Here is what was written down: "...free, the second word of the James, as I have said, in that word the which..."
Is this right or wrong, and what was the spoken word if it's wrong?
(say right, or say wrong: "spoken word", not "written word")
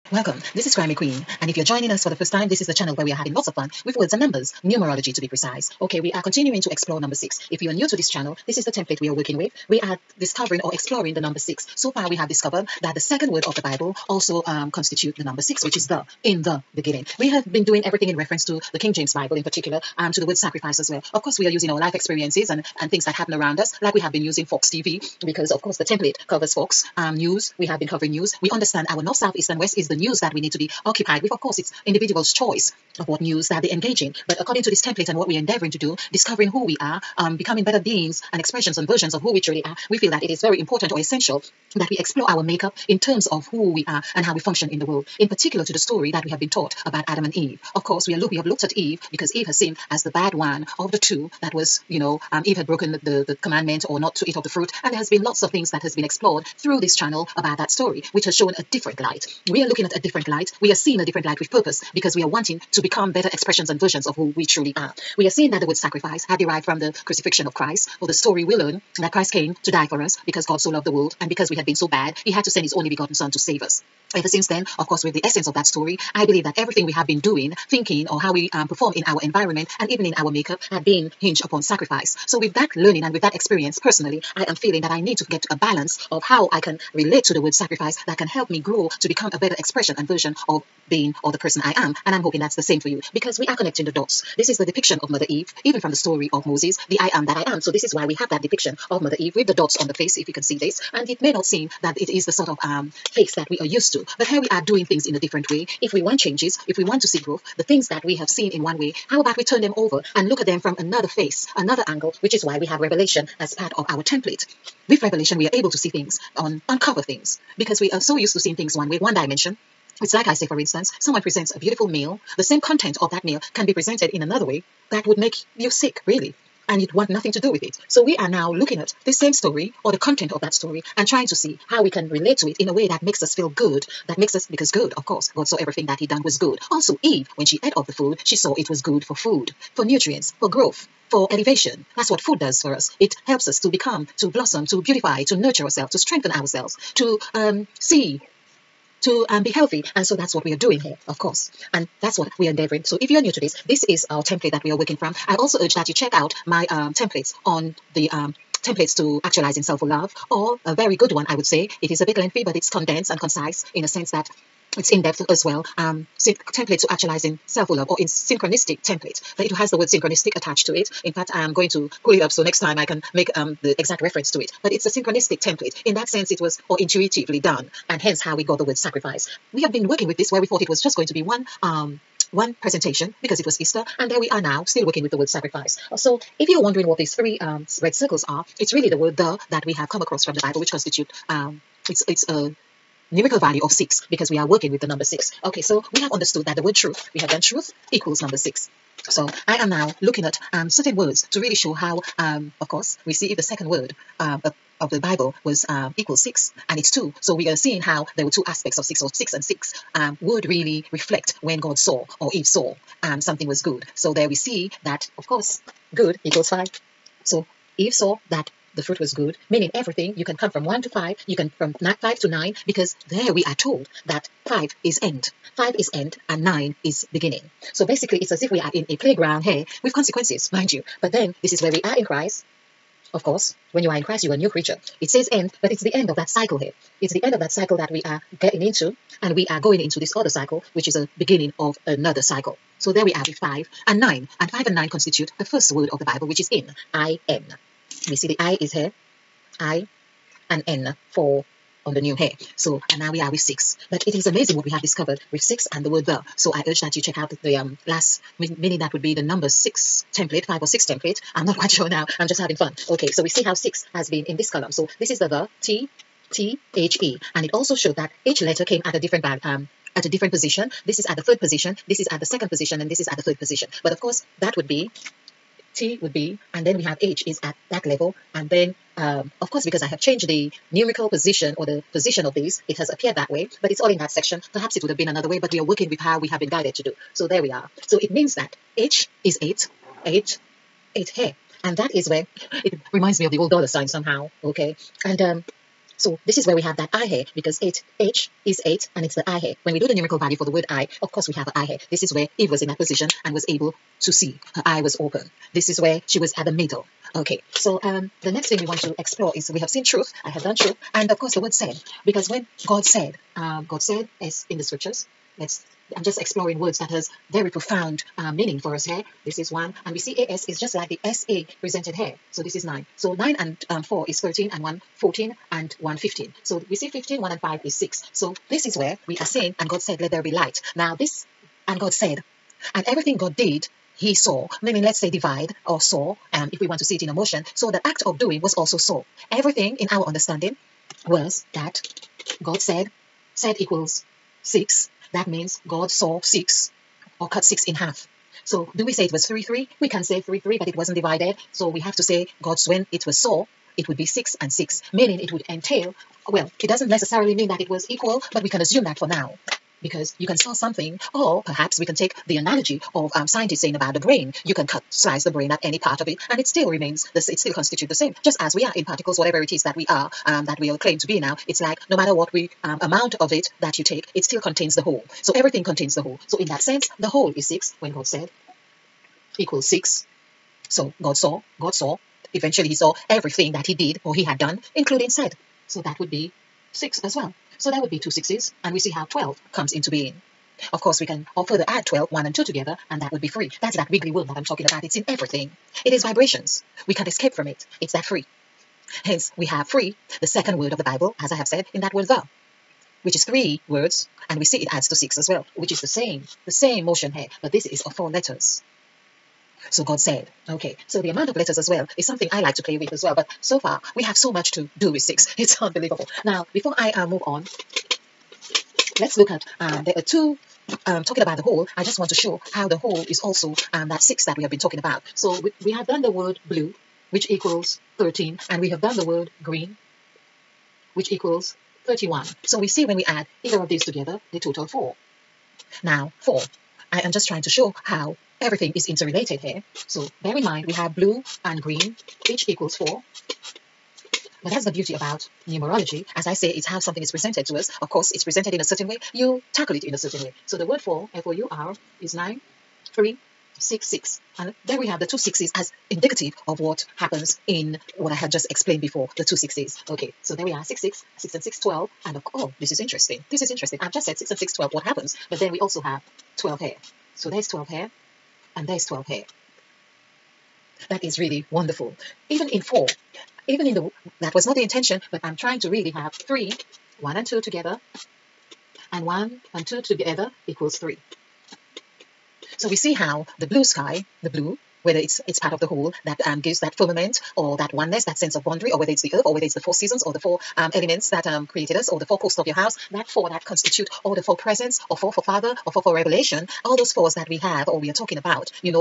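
wrong: "Bible", not "James".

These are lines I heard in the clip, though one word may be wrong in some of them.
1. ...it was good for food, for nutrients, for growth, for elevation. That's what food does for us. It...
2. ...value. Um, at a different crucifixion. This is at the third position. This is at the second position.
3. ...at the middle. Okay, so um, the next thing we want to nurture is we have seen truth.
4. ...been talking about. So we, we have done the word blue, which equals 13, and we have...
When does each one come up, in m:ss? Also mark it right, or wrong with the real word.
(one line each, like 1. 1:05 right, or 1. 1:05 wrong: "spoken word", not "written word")
1. 2:18 right
2. 4:29 wrong: "position", not "crucifixion"
3. 5:06 wrong: "explore", not "nurture"
4. 7:04 right.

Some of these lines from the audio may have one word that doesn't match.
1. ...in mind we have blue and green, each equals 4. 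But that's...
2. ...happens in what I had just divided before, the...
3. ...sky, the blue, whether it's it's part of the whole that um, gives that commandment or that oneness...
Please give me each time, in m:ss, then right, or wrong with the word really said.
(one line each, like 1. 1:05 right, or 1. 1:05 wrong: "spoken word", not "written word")
1. 7:20 right
2. 7:36 wrong: "explained", not "divided"
3. 8:03 wrong: "firmament", not "commandment".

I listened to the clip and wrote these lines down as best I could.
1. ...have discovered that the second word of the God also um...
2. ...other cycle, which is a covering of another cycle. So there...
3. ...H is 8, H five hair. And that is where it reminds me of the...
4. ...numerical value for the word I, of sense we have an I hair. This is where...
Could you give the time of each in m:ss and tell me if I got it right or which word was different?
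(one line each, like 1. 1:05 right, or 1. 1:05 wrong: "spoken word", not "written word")
1. 0:12 wrong: "Bible", not "God"
2. 4:00 wrong: "beginning", not "covering"
3. 4:48 wrong: "eight", not "five"
4. 4:59 wrong: "course", not "sense".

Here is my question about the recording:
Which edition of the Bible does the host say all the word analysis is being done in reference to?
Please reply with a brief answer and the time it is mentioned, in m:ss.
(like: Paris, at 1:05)
King James Bible, at 0:18.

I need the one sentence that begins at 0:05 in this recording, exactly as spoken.
Okay, we are continuing to explore number six.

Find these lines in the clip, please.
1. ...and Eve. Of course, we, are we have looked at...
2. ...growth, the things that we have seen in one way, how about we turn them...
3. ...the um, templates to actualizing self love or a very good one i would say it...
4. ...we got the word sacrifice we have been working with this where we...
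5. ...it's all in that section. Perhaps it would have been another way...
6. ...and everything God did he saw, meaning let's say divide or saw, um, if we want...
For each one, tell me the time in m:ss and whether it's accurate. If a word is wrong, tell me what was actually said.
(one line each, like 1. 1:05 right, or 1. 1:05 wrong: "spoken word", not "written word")
1. 0:47 right
2. 1:47 right
3. 2:37 right
4. 2:58 right
5. 4:43 right
6. 5:32 right.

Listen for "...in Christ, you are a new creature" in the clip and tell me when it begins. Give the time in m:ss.
3:53.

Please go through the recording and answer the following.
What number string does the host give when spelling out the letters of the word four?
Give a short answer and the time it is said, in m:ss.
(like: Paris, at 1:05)
9366, at 7:32.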